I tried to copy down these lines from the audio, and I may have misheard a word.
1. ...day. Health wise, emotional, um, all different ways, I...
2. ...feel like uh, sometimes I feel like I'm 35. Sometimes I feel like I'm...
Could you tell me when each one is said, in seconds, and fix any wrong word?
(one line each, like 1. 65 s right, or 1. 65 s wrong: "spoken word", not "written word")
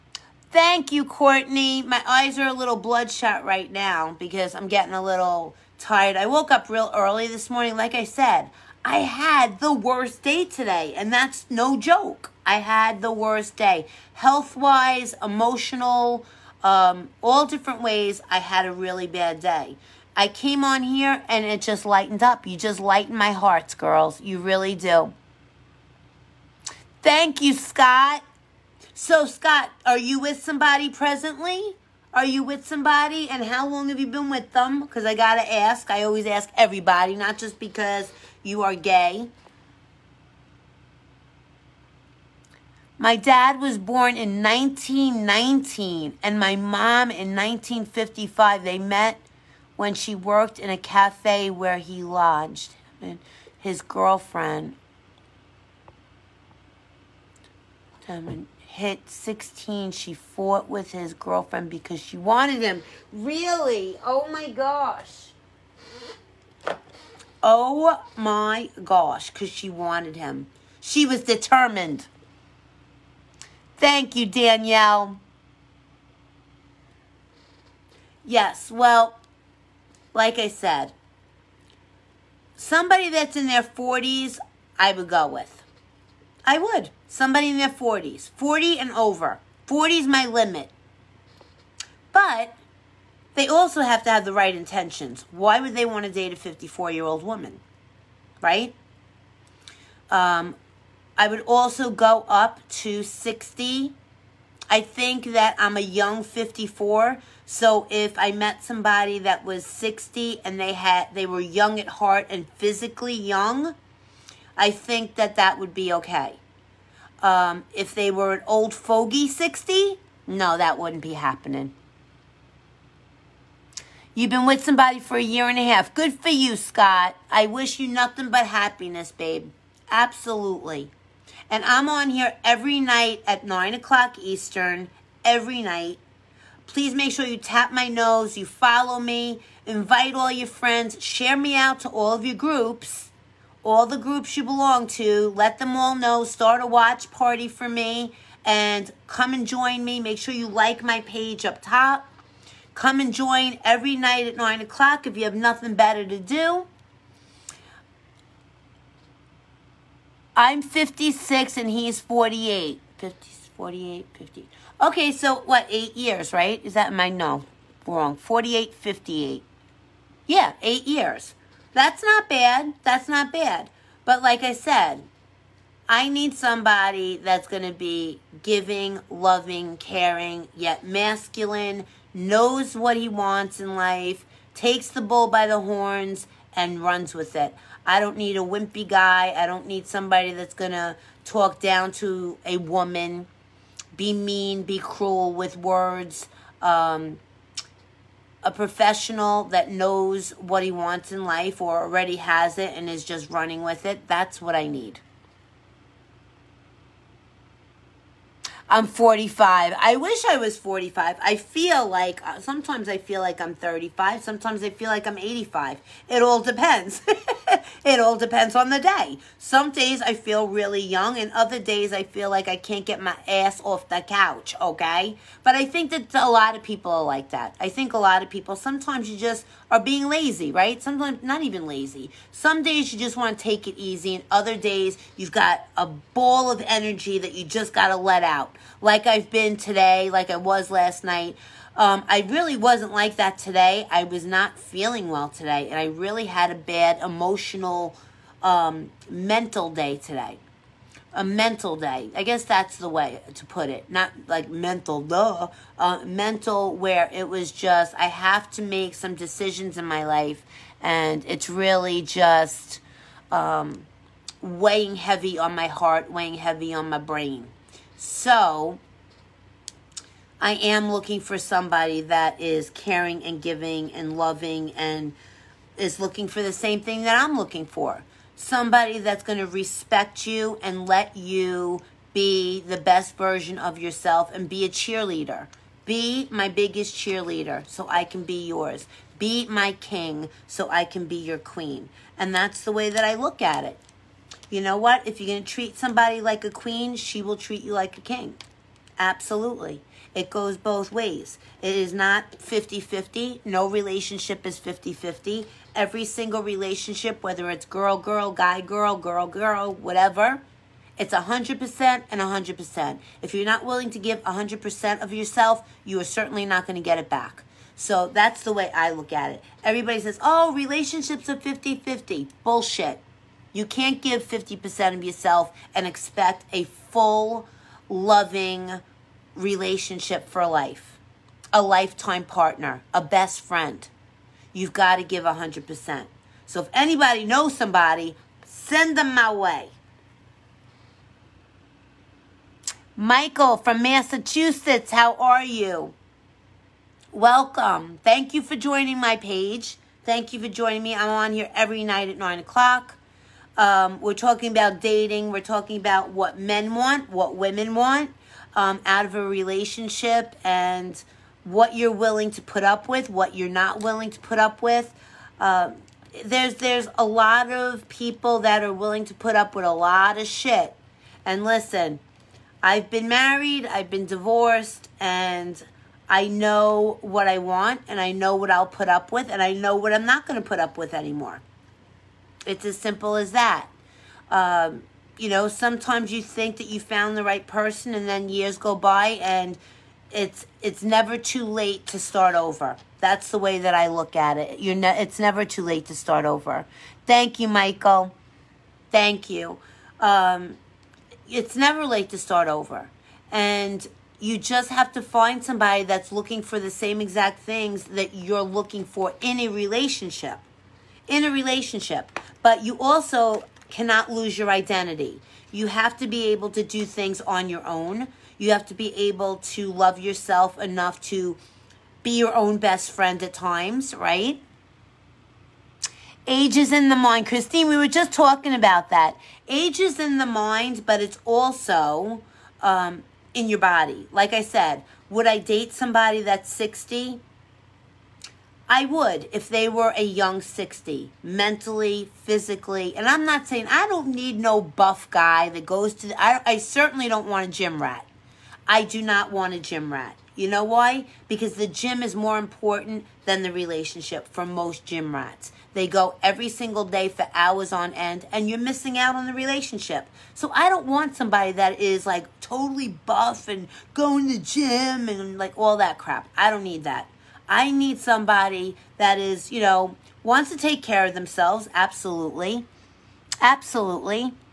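1. 13 s right
2. 211 s right.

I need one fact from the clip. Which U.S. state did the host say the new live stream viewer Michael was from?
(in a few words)
Massachusetts.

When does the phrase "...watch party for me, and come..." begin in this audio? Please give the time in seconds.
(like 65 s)
146 s.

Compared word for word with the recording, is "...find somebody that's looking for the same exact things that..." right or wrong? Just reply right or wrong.
right.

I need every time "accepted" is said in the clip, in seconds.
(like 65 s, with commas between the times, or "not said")
not said.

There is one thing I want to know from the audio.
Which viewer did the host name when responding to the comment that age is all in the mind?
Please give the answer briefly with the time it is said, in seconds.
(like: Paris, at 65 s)
Christine, at 427 s.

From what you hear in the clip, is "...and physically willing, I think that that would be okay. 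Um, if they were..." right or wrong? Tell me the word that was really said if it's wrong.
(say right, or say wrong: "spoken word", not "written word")
wrong: "young", not "willing".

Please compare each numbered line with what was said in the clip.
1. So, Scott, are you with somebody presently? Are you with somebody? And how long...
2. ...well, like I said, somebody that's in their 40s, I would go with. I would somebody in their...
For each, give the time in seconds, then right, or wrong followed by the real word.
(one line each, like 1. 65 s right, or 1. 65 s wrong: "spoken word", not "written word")
1. 28 s right
2. 78 s right.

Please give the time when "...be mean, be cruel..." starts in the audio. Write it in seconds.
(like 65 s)
193 s.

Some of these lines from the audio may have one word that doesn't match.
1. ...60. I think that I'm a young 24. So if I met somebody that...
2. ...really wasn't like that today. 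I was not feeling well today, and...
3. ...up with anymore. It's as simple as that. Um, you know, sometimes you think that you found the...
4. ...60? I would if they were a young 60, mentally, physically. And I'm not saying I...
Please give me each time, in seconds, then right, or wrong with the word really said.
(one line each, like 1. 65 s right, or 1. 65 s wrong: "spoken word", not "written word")
1. 103 s wrong: "54", not "24"
2. 242 s right
3. 380 s right
4. 436 s right.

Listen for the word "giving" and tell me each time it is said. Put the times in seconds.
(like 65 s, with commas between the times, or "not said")
178 s, 273 s.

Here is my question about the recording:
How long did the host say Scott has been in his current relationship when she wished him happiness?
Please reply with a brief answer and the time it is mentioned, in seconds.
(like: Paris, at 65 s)
A year and a half, at 125 s.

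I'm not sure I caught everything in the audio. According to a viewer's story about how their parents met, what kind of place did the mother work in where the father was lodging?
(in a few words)
A cafe.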